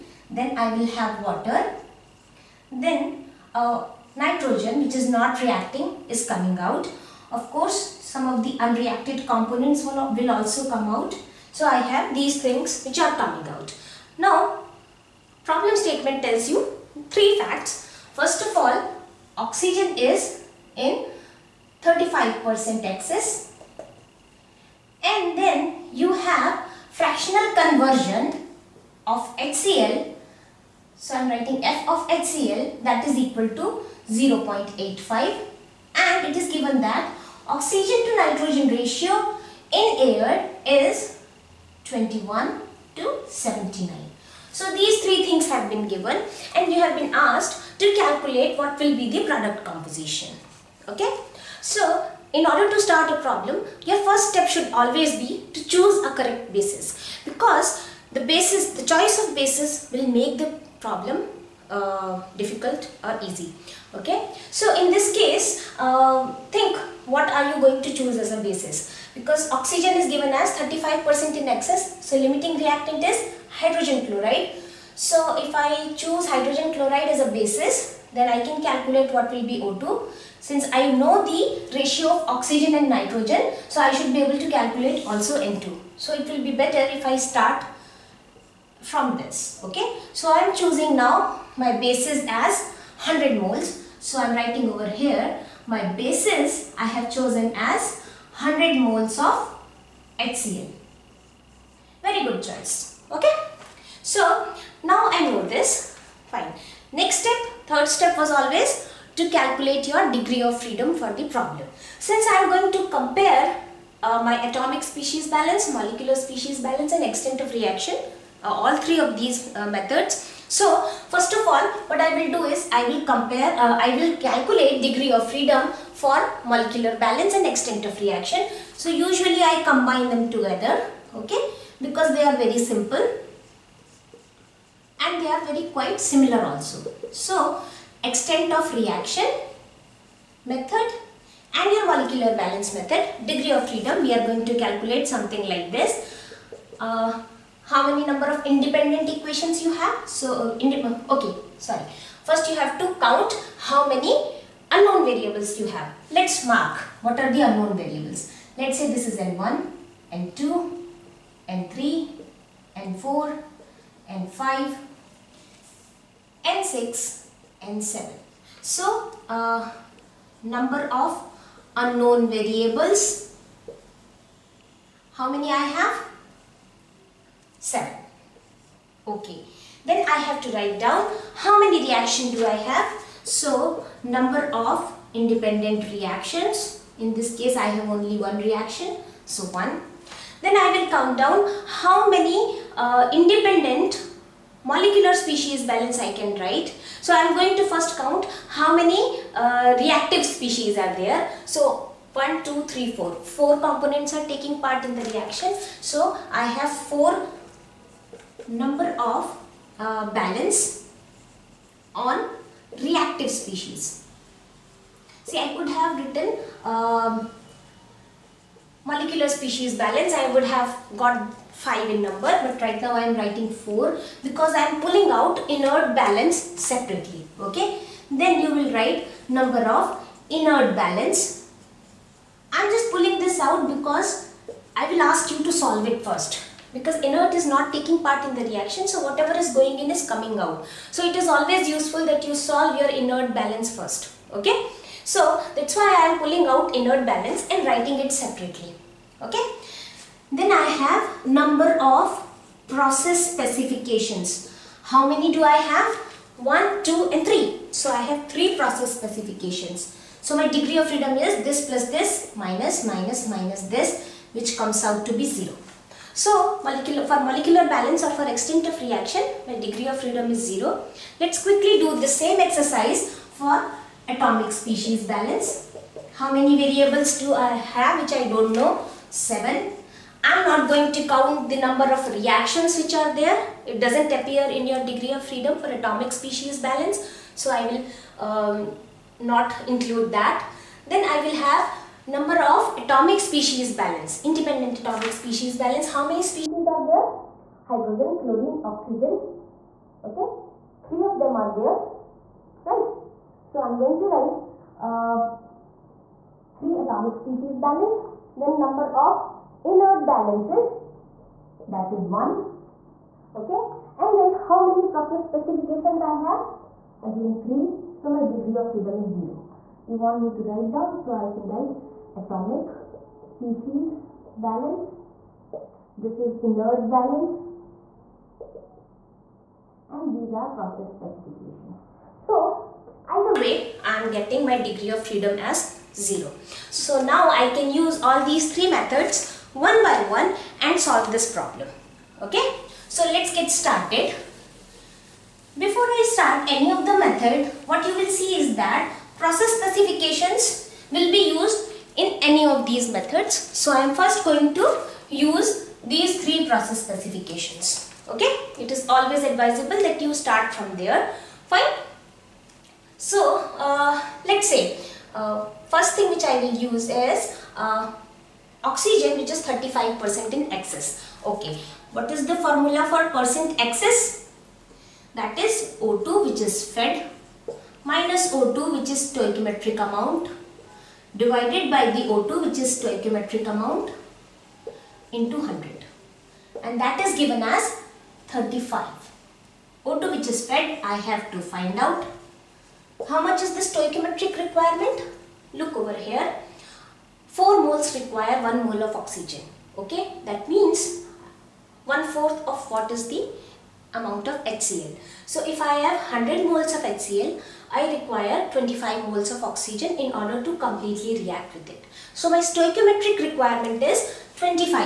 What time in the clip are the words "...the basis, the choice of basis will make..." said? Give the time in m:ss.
0:58.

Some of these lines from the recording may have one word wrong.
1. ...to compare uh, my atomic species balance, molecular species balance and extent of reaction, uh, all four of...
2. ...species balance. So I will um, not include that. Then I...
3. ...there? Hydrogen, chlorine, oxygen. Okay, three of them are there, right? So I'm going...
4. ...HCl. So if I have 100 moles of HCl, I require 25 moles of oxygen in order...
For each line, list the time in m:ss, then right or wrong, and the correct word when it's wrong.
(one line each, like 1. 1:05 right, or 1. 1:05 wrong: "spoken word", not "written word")
1. 1:52 wrong: "three", not "four"
2. 4:46 right
3. 4:56 right
4. 6:44 right.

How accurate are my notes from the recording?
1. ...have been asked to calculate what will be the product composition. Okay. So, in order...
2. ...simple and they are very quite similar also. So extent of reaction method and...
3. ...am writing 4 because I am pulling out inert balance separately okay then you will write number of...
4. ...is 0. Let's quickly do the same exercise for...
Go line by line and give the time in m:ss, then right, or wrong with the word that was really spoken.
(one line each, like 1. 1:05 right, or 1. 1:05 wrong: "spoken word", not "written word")
1. 0:46 right
2. 2:12 right
3. 3:43 right
4. 4:30 right.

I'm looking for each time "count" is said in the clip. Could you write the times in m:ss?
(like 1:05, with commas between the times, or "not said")
2:33, 3:10, 3:17, 4:41.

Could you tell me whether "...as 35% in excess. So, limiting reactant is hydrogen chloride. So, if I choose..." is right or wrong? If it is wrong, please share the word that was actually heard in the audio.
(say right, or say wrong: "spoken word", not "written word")
right.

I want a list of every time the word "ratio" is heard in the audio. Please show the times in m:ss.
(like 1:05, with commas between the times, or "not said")
0:38, 1:21.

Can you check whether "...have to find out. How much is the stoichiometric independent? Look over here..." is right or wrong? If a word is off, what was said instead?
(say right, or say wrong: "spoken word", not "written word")
wrong: "requirement", not "independent".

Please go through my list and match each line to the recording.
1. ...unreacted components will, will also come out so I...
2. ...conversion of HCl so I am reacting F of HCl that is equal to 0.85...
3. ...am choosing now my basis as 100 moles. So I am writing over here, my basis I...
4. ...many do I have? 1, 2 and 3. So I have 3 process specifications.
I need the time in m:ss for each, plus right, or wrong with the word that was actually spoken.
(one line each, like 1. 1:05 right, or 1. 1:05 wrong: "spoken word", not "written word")
1. 0:08 right
2. 0:27 wrong: "writing", not "reacting"
3. 1:30 right
4. 4:15 right.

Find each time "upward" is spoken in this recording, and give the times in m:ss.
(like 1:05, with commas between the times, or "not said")
not said.